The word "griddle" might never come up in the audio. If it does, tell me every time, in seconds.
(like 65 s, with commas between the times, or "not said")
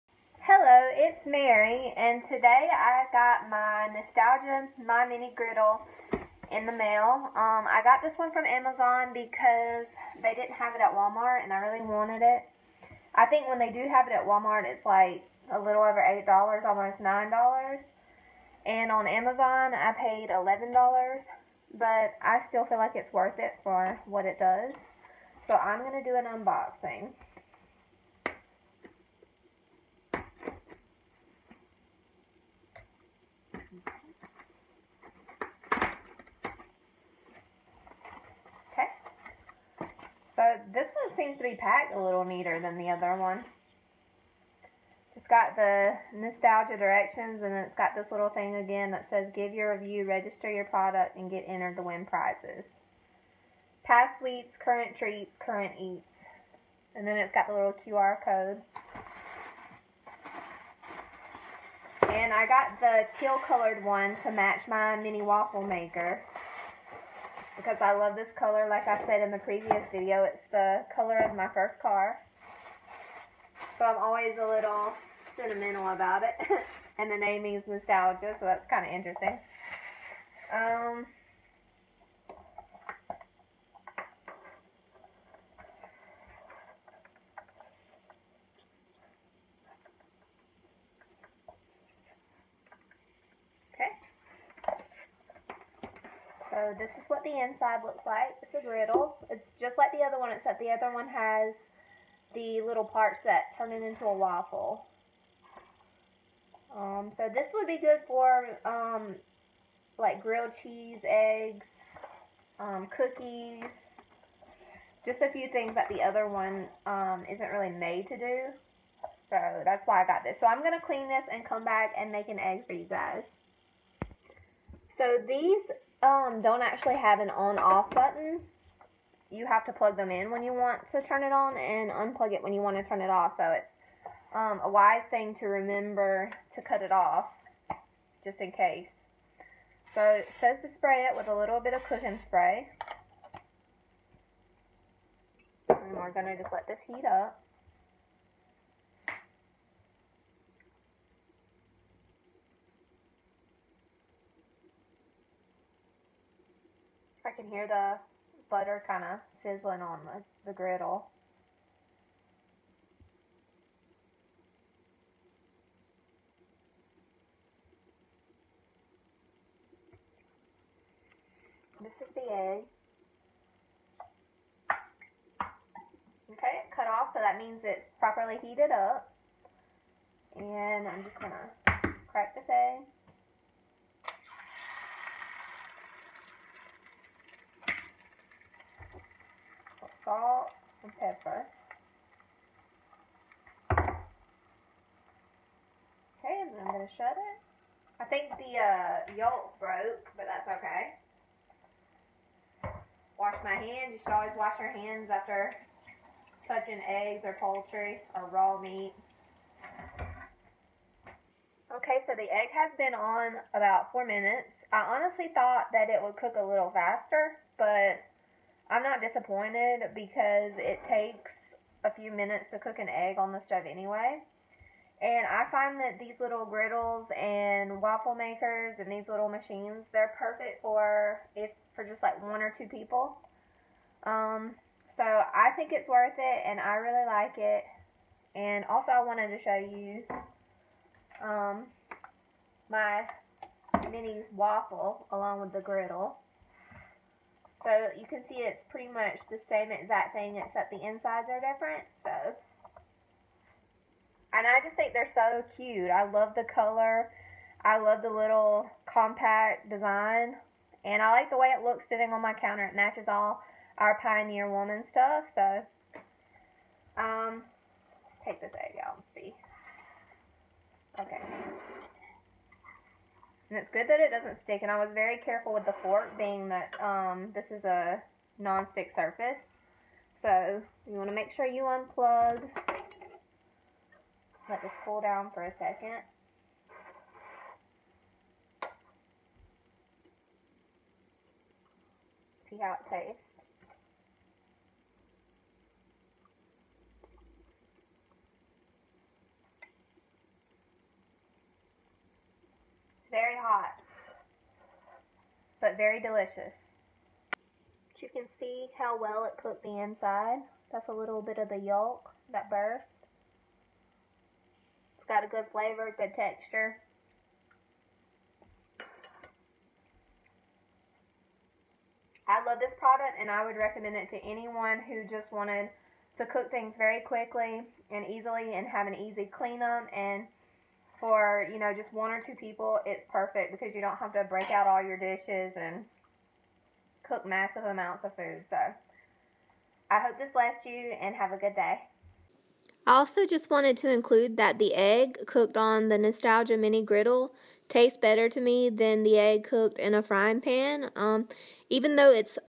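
5 s, 98 s, 160 s, 226 s, 245 s, 346 s.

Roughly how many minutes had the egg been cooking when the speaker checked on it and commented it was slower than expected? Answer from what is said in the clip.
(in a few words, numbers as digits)
4.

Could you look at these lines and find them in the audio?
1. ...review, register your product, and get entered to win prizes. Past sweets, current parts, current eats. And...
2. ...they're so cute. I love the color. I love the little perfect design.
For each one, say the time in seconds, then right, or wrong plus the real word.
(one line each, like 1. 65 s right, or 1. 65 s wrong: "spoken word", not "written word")
1. 49 s wrong: "treats", not "parts"
2. 254 s wrong: "compact", not "perfect".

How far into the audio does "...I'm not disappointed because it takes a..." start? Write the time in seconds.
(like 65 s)
218 s.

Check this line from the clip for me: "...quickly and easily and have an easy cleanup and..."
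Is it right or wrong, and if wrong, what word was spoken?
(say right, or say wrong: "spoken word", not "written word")
right.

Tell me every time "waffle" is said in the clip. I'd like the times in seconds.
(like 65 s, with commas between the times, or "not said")
65 s, 104 s, 227 s, 244 s.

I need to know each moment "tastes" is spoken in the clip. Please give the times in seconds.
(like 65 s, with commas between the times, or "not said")
292 s, 347 s.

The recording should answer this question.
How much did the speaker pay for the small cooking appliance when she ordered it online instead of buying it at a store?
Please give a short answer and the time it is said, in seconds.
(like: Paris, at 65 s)
$11, at 20 s.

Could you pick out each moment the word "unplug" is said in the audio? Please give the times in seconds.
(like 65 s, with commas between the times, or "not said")
131 s, 281 s.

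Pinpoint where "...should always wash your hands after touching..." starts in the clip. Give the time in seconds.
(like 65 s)
204 s.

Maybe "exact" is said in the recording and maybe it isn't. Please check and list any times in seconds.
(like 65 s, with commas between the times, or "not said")
249 s.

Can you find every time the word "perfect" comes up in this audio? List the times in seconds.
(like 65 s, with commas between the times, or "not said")
230 s, 333 s.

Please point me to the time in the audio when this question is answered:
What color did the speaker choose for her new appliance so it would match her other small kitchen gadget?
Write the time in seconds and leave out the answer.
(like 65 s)
63 s.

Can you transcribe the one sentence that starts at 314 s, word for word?
It's got a good flavor, good texture.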